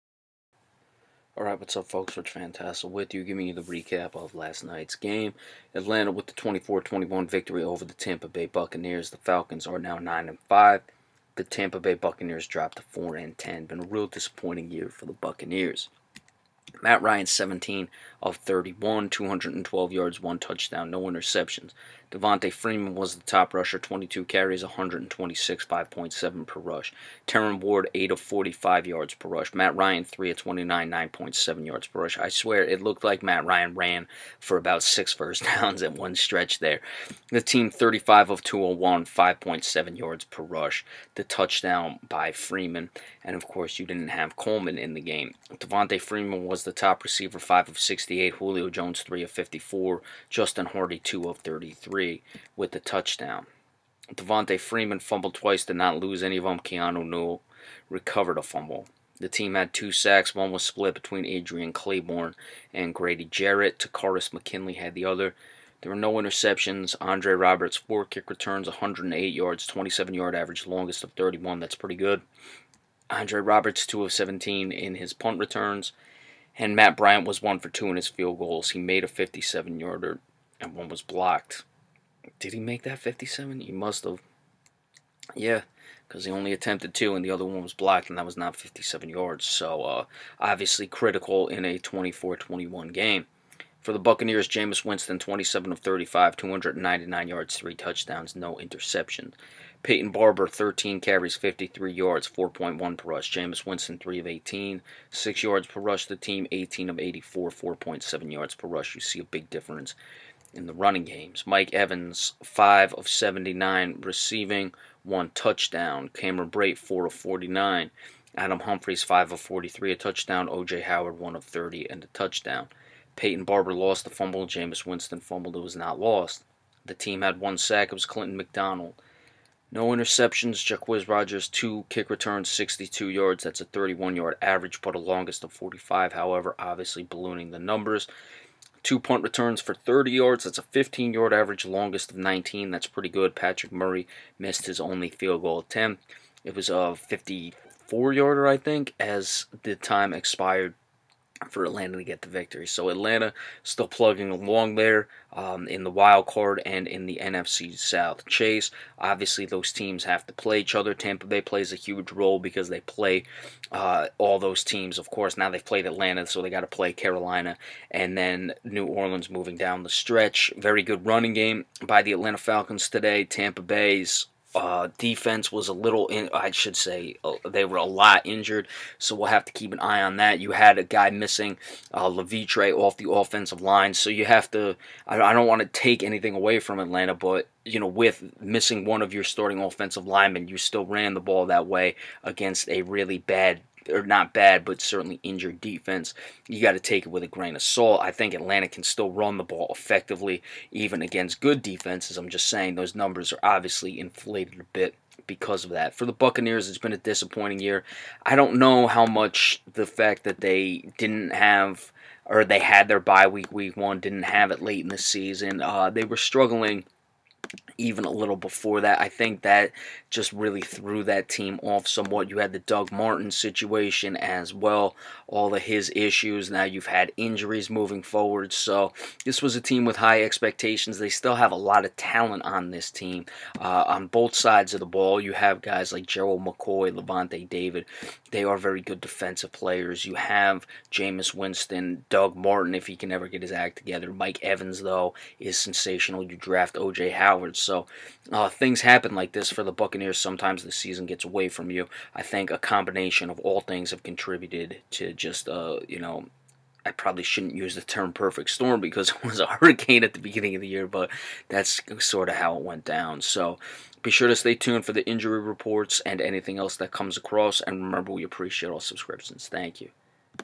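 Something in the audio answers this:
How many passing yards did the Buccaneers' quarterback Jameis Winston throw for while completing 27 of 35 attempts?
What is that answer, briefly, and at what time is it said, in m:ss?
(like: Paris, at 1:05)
299, at 1:36.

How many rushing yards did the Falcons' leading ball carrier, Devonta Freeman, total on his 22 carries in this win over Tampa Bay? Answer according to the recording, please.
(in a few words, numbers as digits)
126.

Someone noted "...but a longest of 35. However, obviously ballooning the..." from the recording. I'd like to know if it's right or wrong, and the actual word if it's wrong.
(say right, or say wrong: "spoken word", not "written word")
wrong: "45", not "35".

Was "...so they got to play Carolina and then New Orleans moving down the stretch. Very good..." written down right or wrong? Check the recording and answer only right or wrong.
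right.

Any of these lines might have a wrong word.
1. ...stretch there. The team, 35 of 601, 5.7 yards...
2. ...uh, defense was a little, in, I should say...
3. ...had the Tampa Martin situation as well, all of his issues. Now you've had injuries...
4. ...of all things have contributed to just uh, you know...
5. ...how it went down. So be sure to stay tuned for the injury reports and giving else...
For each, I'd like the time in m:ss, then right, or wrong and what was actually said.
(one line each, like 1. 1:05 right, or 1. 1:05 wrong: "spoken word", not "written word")
1. 0:36 wrong: "201", not "601"
2. 2:54 right
3. 3:42 wrong: "Doug", not "Tampa"
4. 4:13 right
5. 4:22 wrong: "anything", not "giving".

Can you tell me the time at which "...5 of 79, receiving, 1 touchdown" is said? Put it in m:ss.
1:52.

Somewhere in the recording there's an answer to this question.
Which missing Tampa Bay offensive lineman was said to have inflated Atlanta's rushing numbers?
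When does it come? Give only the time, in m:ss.
3:02.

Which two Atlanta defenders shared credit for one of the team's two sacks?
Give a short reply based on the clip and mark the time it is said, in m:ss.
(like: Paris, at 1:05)
Adrian Clayborn and Grady Jarrett, at 1:01.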